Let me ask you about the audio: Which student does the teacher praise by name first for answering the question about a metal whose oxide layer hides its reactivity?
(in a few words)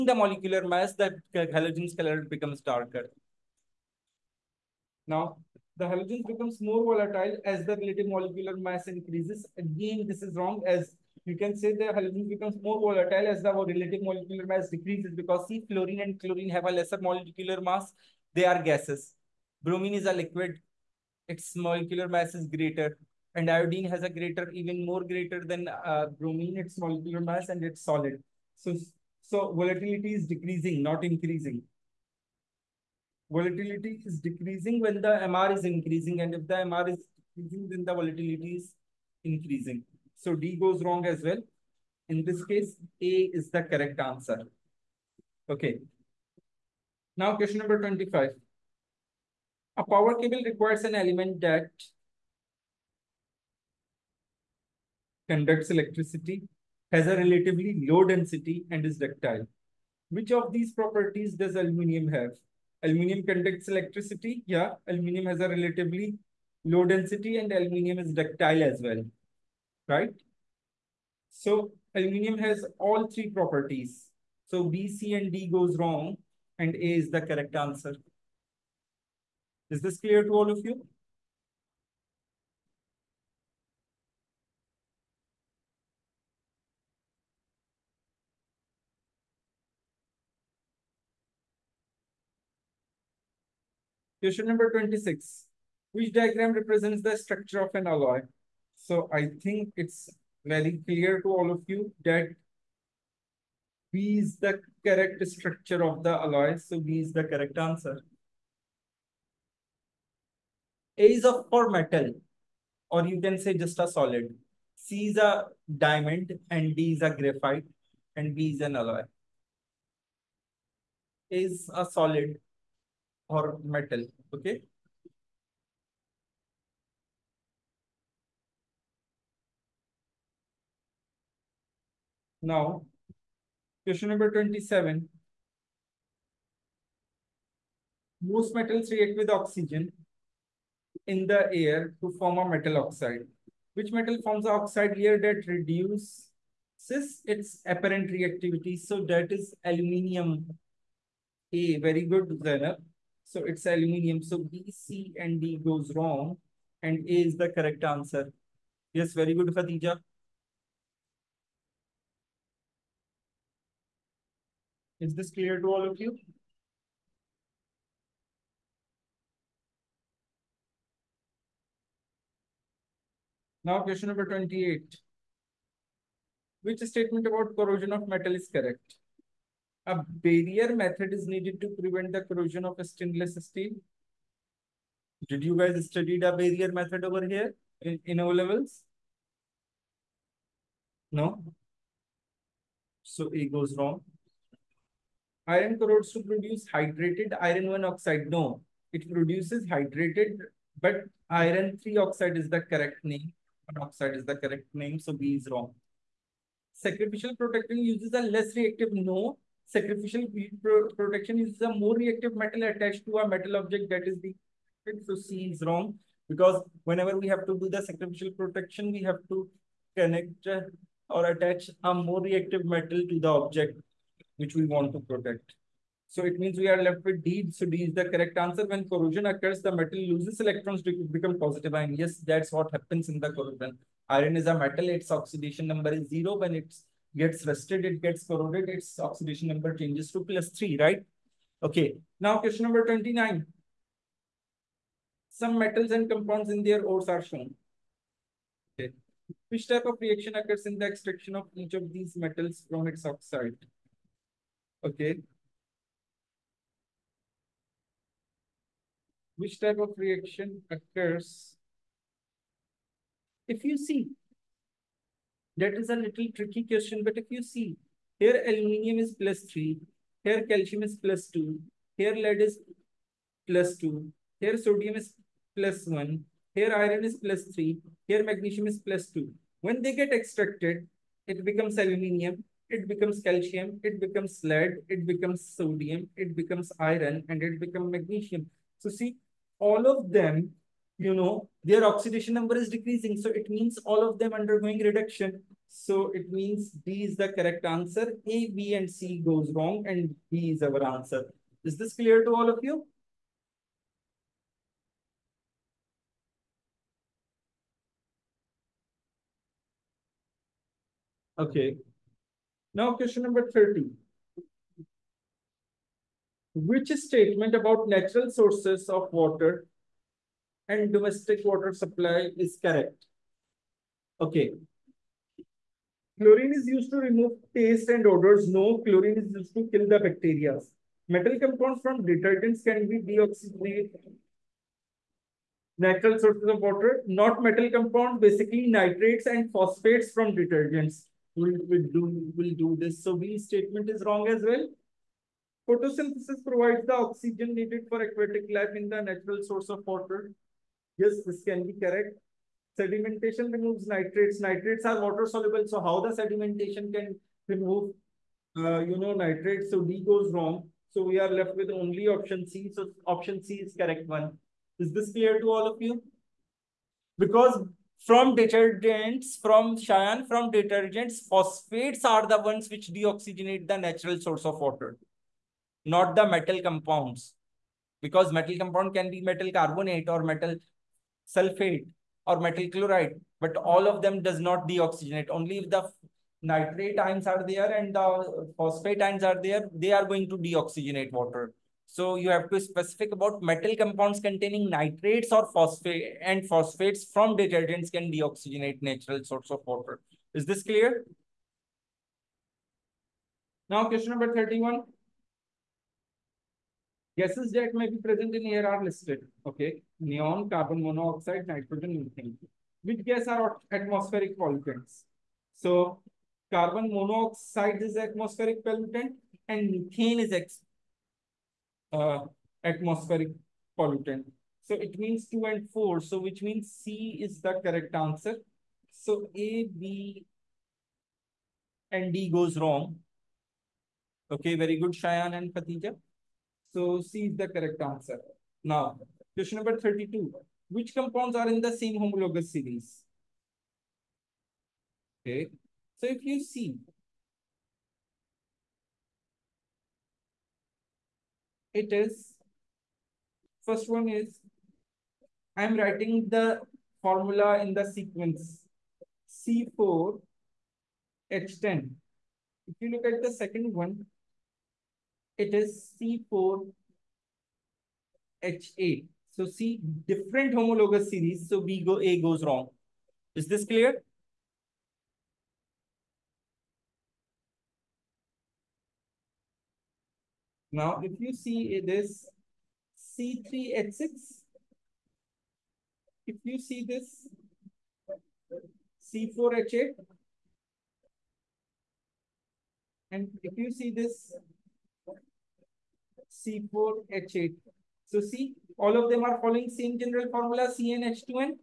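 Zainab.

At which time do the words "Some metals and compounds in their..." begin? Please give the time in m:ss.
4:05.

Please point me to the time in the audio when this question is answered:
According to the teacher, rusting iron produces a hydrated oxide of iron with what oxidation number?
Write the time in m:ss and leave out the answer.
3:21.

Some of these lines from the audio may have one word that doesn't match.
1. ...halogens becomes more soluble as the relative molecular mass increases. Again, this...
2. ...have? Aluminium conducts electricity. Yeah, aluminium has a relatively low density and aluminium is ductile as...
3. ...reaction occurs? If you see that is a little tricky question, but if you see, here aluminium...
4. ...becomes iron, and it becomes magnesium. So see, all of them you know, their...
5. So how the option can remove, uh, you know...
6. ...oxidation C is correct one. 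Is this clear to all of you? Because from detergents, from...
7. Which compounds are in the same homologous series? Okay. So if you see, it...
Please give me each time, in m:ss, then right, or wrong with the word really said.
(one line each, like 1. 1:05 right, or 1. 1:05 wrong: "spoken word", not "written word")
1. 0:05 wrong: "volatile", not "soluble"
2. 1:02 right
3. 4:19 right
4. 4:46 right
5. 5:55 wrong: "sedimentation", not "option"
6. 6:03 wrong: "option", not "oxidation"
7. 7:20 right.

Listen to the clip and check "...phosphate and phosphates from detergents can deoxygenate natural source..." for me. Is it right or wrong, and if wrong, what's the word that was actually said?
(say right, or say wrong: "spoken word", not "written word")
right.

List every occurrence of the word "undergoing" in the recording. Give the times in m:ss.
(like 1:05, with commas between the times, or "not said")
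4:54.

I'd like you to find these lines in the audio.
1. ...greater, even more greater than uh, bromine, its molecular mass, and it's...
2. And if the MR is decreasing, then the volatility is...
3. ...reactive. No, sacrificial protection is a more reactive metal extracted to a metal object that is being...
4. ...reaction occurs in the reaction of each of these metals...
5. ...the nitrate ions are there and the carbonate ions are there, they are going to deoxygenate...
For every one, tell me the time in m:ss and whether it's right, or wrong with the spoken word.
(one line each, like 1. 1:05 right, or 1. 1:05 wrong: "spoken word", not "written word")
1. 0:24 right
2. 0:36 right
3. 3:28 wrong: "attached", not "extracted"
4. 4:09 wrong: "extraction", not "reaction"
5. 6:25 wrong: "phosphate", not "carbonate".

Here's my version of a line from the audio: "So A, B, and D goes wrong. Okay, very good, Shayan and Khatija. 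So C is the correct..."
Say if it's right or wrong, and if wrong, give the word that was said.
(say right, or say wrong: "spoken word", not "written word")
right.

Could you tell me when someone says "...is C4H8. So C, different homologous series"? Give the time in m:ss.
7:45.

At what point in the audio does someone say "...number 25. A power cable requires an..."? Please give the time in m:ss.
0:47.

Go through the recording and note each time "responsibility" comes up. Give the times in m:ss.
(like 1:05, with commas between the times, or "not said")
not said.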